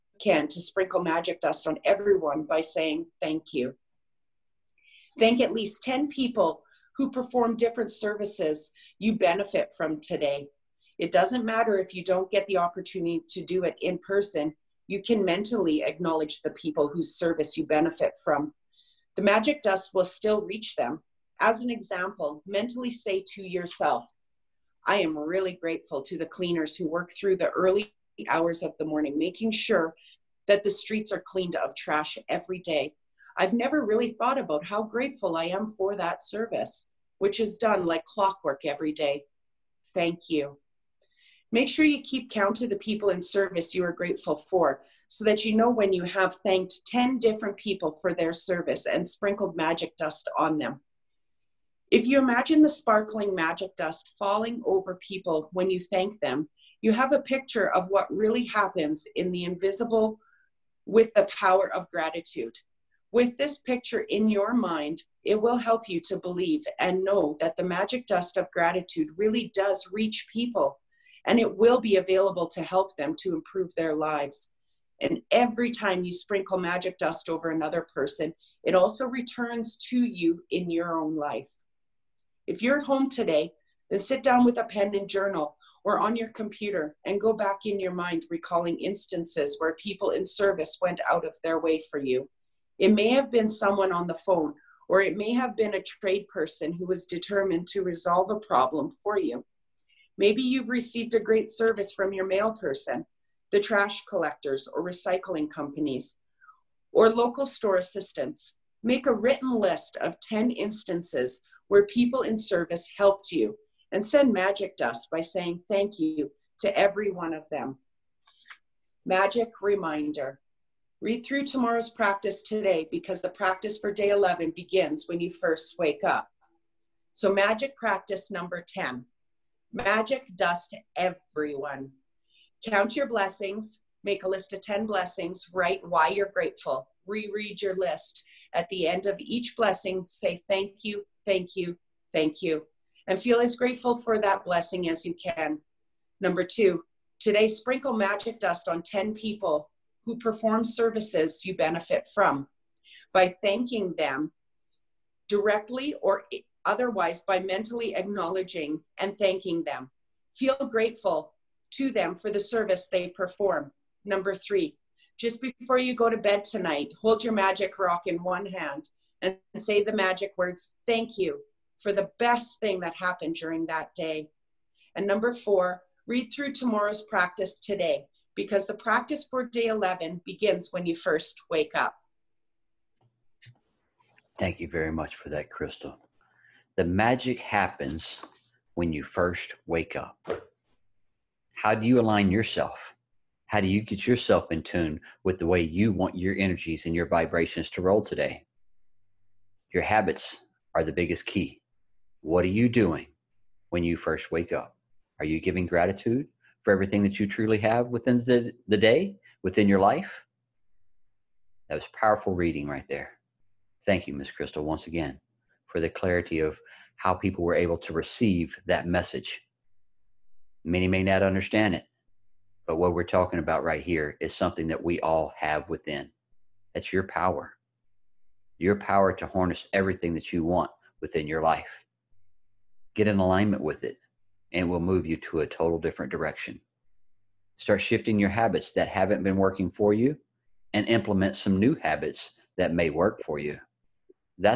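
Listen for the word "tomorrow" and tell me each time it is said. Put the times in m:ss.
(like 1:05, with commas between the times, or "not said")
2:01, 2:56.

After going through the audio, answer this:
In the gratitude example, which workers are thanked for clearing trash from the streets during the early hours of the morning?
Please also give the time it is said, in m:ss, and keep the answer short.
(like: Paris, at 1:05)
cleaners, at 0:26.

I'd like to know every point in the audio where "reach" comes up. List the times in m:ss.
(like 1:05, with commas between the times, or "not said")
0:20, 1:09.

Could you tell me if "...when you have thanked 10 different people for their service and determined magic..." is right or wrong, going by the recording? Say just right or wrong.
wrong.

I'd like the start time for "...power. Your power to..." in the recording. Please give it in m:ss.
3:47.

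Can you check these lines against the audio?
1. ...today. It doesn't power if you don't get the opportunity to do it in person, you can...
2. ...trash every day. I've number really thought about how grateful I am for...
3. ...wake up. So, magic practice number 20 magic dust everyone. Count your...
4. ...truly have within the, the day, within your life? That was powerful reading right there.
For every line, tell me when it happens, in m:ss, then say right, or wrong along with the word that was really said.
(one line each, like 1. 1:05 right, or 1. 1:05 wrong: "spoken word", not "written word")
1. 0:09 wrong: "matter", not "power"
2. 0:31 wrong: "never", not "number"
3. 2:05 wrong: "10", not "20"
4. 3:27 right.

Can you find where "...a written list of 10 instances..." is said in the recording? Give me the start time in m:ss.
1:49.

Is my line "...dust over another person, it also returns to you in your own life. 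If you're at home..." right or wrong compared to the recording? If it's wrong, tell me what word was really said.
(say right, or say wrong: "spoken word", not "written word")
right.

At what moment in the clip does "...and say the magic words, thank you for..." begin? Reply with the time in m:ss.
2:49.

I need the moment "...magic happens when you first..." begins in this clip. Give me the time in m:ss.
3:06.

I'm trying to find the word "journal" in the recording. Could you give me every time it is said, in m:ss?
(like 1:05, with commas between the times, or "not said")
1:25.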